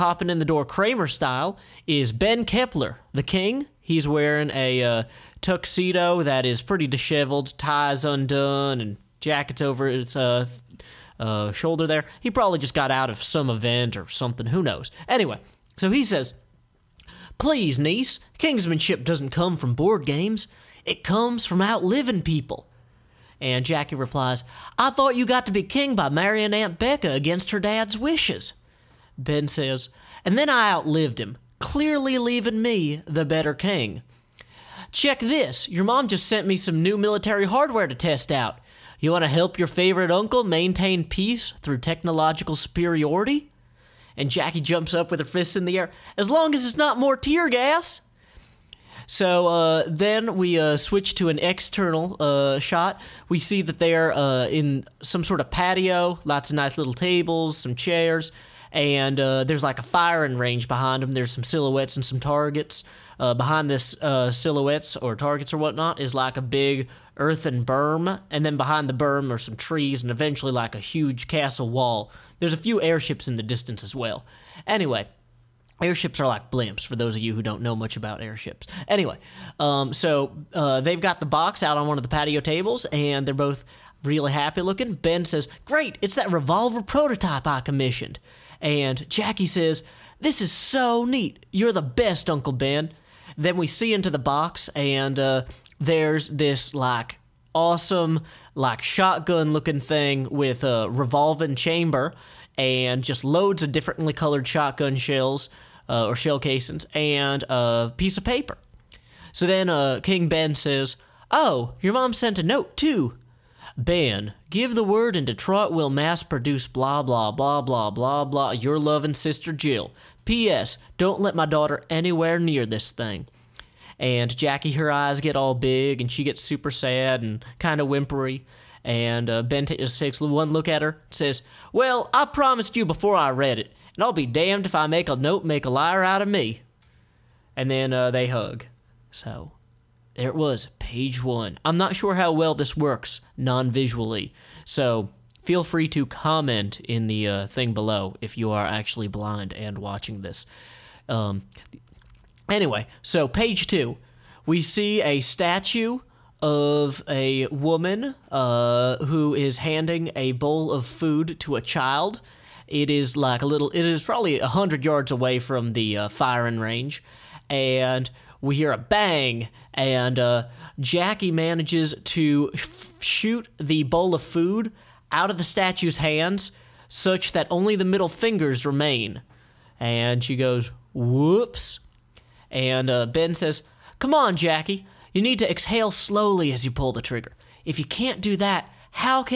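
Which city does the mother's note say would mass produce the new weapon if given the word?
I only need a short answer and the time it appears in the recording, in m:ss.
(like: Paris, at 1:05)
Detroit, at 1:55.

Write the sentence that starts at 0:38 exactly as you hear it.
You want to help your favorite uncle maintain peace through technological superiority?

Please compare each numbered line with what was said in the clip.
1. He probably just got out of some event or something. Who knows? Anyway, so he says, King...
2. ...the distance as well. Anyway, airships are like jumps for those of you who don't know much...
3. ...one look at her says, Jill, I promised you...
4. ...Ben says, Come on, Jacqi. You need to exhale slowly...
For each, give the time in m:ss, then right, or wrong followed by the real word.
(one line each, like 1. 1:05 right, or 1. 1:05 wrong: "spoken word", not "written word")
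1. 0:12 wrong: "Please", not "King"
2. 1:13 wrong: "blimps", not "jumps"
3. 2:10 wrong: "Well", not "Jill"
4. 3:03 right.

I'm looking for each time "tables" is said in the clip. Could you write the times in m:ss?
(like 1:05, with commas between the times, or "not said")
0:56, 1:22.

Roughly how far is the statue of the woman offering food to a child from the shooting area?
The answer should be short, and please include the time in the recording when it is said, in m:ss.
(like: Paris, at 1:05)
100 yards, at 2:44.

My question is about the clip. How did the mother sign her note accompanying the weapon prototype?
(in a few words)
Jill.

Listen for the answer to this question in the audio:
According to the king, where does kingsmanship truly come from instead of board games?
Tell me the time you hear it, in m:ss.
0:21.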